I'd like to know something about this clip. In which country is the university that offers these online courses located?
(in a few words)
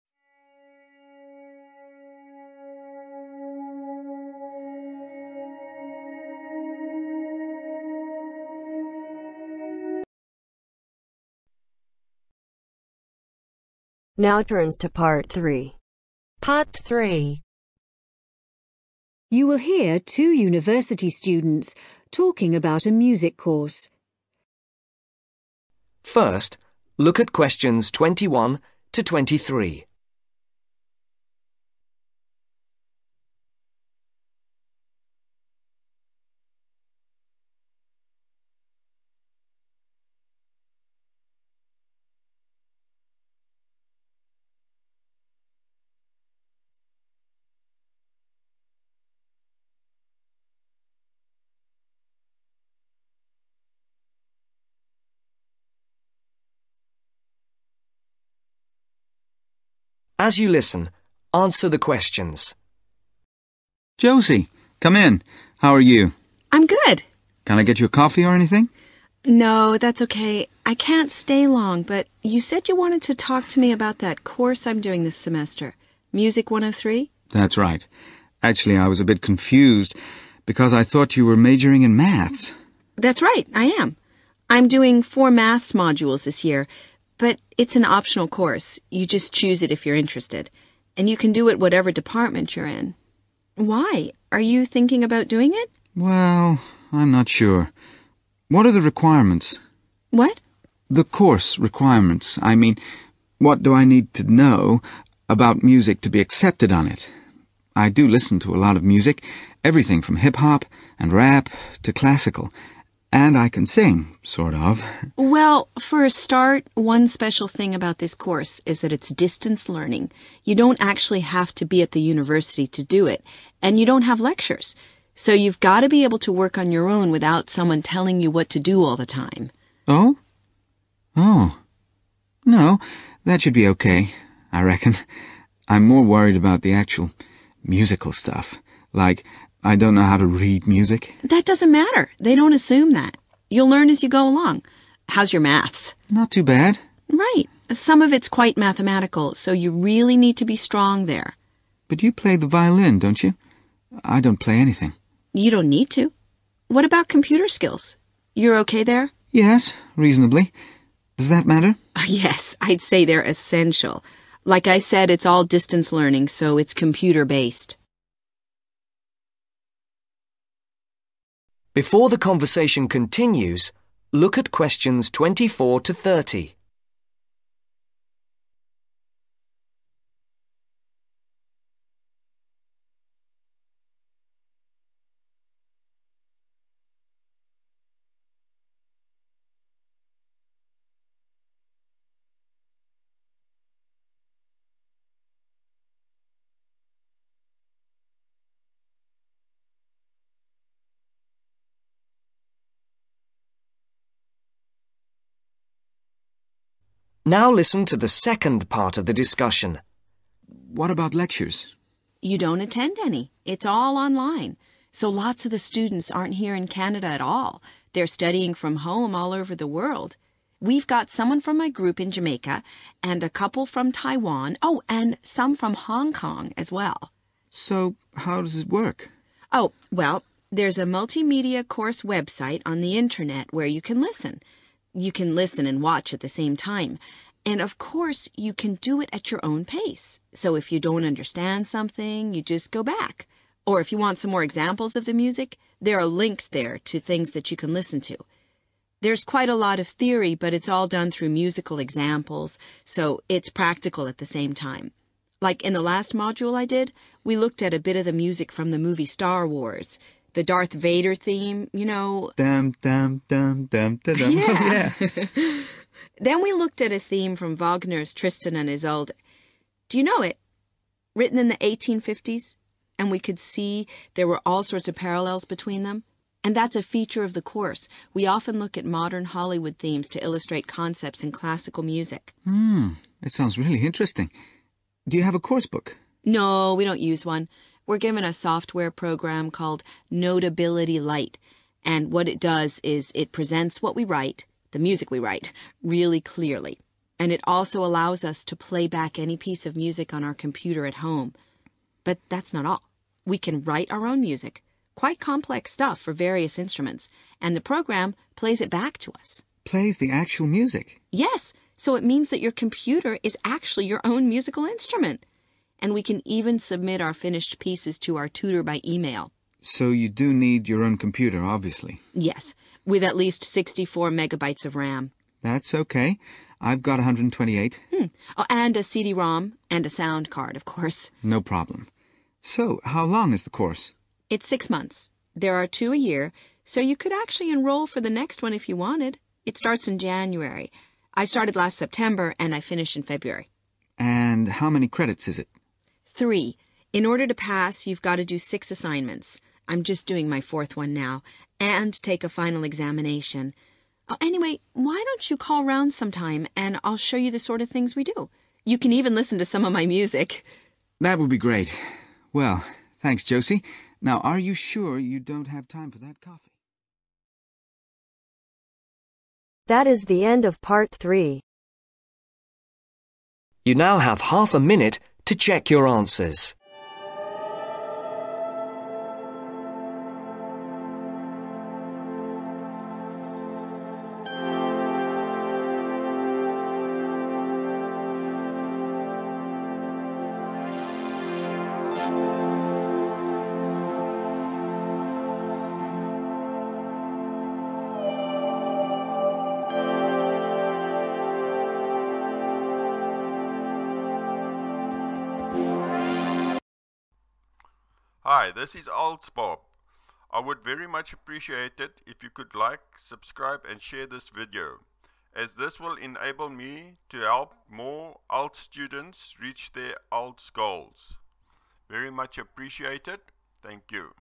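Canada.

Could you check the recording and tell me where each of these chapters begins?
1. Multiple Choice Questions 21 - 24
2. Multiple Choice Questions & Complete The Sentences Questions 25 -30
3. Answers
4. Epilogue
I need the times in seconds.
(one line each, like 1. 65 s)
1. 10 s
2. 176 s
3. 376 s
4. 406 s.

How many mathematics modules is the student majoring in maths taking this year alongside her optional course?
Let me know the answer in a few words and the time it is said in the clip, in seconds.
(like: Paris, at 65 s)
4, at 85 s.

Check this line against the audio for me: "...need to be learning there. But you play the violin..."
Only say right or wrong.
wrong.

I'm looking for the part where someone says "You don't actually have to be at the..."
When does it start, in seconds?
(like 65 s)
120 s.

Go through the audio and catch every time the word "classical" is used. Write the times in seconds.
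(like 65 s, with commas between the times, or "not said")
111 s, 281 s.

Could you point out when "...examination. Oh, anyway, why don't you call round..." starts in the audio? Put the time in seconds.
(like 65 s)
352 s.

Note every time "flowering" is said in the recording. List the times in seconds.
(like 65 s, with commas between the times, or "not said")
not said.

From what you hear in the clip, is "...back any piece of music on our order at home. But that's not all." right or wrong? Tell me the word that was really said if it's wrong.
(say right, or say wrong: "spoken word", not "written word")
wrong: "computer", not "order".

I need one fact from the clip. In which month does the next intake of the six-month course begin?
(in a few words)
January.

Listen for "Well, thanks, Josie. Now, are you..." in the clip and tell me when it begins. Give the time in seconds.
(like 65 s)
362 s.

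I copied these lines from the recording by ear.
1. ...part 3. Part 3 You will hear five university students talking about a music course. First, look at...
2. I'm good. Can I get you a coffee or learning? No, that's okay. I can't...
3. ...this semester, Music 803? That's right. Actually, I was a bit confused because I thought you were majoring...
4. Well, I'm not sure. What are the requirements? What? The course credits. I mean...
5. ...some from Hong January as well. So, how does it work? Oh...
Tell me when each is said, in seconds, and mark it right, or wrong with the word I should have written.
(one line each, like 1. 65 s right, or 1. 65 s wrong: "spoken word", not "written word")
1. 14 s wrong: "two", not "five"
2. 66 s wrong: "anything", not "learning"
3. 75 s wrong: "103", not "803"
4. 95 s wrong: "requirements", not "credits"
5. 225 s wrong: "Kong", not "January".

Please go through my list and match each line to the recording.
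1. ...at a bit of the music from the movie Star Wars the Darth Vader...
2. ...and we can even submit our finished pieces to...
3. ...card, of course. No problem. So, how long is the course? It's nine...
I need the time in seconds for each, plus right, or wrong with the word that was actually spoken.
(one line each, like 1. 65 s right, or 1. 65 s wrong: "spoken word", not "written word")
1. 257 s right
2. 315 s right
3. 330 s wrong: "six", not "nine".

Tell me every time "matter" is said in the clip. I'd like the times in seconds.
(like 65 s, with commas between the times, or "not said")
141 s, 161 s.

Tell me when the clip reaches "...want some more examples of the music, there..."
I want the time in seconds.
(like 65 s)
243 s.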